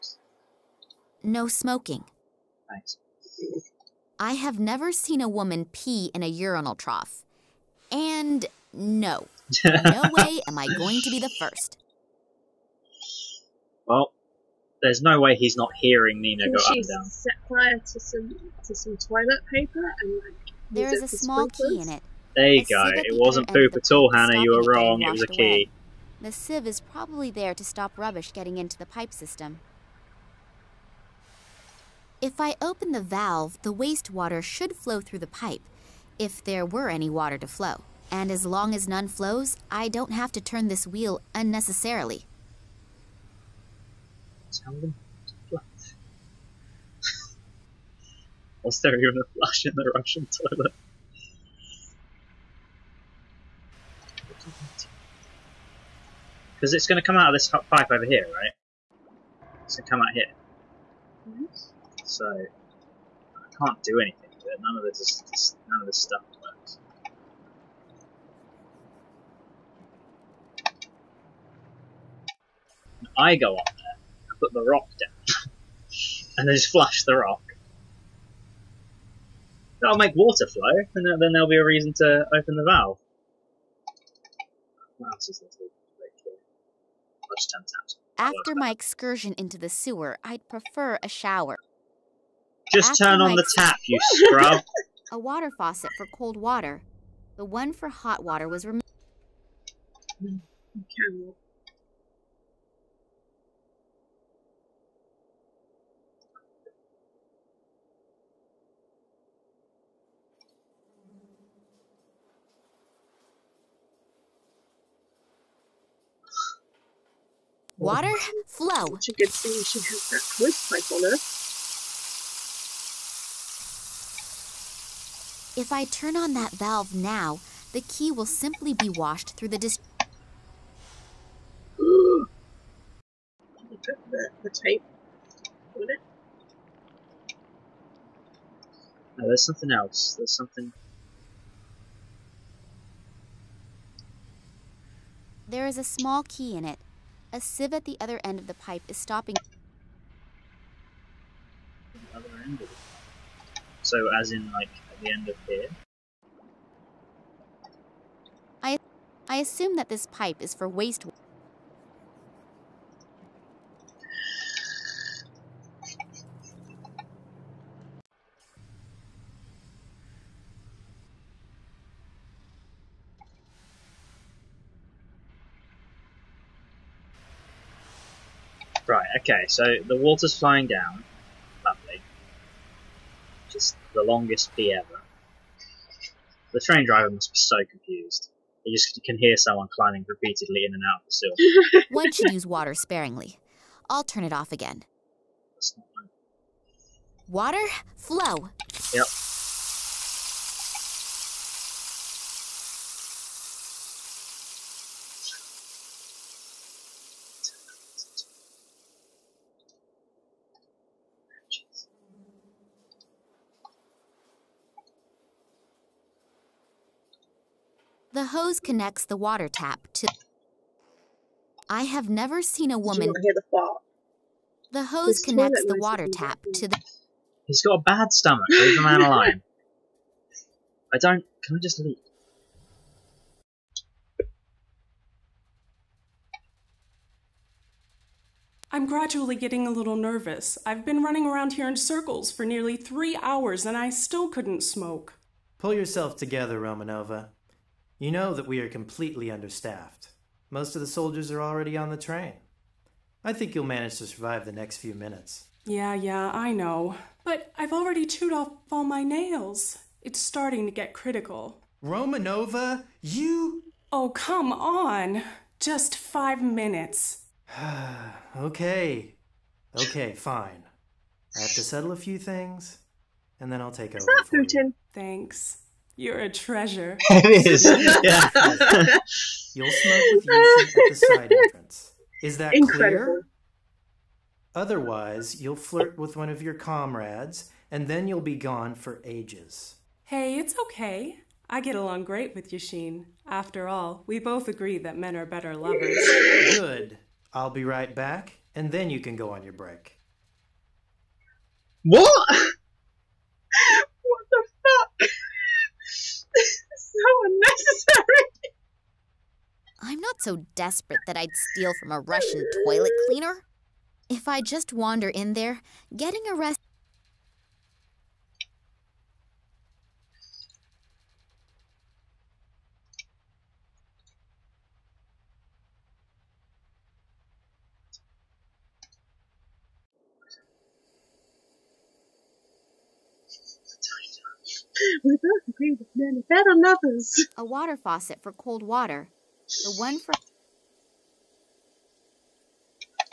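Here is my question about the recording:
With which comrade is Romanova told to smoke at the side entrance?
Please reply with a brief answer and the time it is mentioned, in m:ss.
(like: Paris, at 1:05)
Yushin, at 4:40.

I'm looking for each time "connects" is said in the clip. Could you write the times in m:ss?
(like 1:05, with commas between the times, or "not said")
3:38, 3:45.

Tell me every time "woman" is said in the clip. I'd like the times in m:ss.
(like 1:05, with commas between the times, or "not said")
0:05, 3:42.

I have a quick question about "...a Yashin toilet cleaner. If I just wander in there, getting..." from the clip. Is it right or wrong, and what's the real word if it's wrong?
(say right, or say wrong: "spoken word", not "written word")
wrong: "Russian", not "Yashin".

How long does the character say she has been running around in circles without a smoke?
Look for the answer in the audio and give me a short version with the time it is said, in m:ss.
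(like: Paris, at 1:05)
Nearly 3 hours, at 4:02.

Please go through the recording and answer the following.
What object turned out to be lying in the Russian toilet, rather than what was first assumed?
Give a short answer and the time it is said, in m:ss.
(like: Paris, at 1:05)
A key, at 0:25.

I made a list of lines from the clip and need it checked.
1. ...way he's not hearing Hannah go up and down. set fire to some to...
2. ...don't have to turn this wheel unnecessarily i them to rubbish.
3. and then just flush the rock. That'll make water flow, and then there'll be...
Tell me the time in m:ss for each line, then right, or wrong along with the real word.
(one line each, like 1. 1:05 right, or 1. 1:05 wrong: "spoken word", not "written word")
1. 0:15 wrong: "Nina", not "Hannah"
2. 0:39 wrong: "flush", not "rubbish"
3. 1:16 wrong: "flash", not "flush".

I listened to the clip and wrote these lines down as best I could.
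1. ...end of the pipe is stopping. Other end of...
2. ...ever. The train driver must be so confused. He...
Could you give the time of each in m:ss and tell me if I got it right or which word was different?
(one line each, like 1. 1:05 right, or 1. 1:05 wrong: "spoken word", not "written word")
1. 2:28 right
2. 3:04 right.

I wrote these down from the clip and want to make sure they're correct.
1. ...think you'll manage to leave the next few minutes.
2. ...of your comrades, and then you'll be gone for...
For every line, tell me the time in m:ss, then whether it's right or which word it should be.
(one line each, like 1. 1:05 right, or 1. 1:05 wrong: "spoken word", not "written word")
1. 4:13 wrong: "survive", not "leave"
2. 4:46 right.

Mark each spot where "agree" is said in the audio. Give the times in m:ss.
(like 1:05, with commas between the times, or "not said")
4:54, 5:35.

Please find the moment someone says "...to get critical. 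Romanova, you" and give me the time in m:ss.
4:20.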